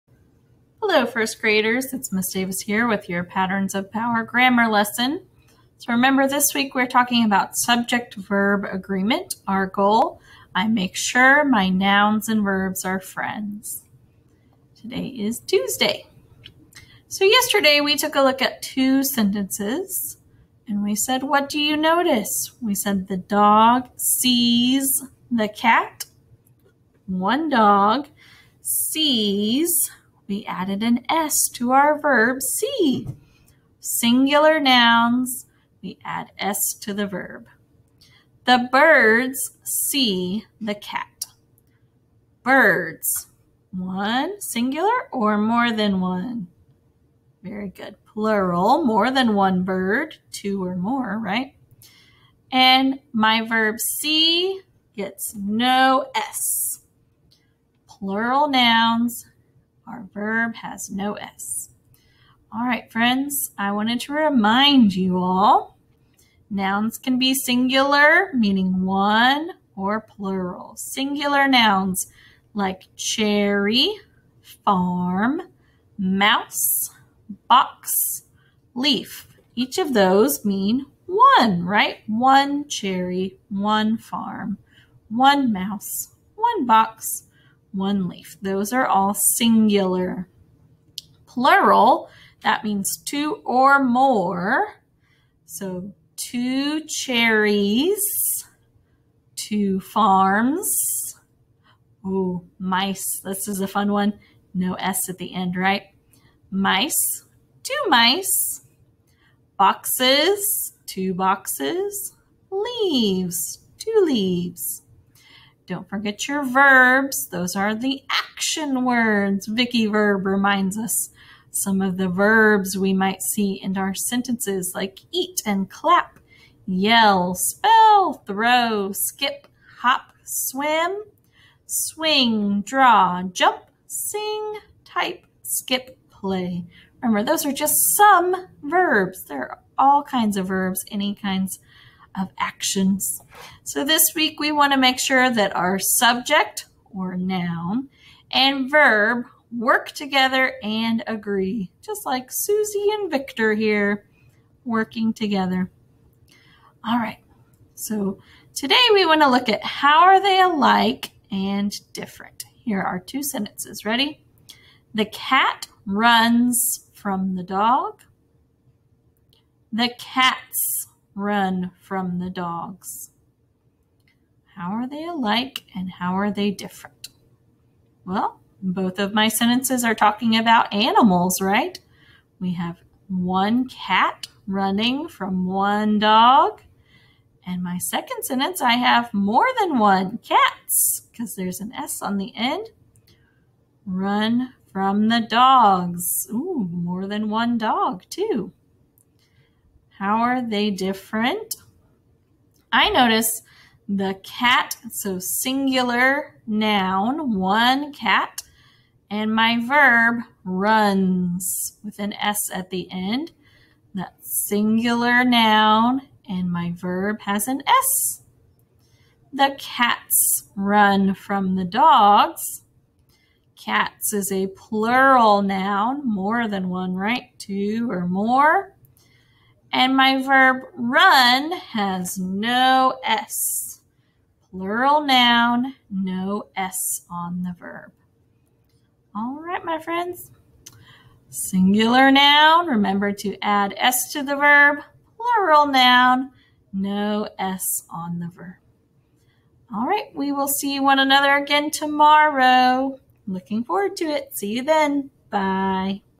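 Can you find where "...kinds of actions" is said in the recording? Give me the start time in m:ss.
2:21.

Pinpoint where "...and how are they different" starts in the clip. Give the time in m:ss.
2:55.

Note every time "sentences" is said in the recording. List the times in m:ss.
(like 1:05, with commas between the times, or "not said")
0:19, 2:03, 2:43, 2:59, 3:08.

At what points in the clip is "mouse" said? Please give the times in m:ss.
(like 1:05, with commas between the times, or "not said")
1:15, 1:25.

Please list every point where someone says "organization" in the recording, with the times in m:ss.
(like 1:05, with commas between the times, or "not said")
not said.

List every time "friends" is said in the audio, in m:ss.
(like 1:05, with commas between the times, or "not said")
0:12, 1:02, 3:59.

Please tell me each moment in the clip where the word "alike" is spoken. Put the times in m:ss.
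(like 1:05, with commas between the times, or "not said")
2:40, 2:55.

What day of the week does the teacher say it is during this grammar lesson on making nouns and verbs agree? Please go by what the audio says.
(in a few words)
Tuesday.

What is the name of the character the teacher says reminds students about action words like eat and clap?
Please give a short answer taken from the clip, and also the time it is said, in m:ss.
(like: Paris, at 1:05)
Vicky Verb, at 1:59.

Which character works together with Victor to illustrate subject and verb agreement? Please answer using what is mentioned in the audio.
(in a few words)
Susie.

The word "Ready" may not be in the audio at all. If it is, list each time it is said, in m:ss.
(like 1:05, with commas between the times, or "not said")
2:43.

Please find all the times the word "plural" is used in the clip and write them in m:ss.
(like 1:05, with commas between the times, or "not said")
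0:48, 0:57, 1:10, 1:31, 3:44, 3:54, 4:05.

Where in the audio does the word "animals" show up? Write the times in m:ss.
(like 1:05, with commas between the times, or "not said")
3:00.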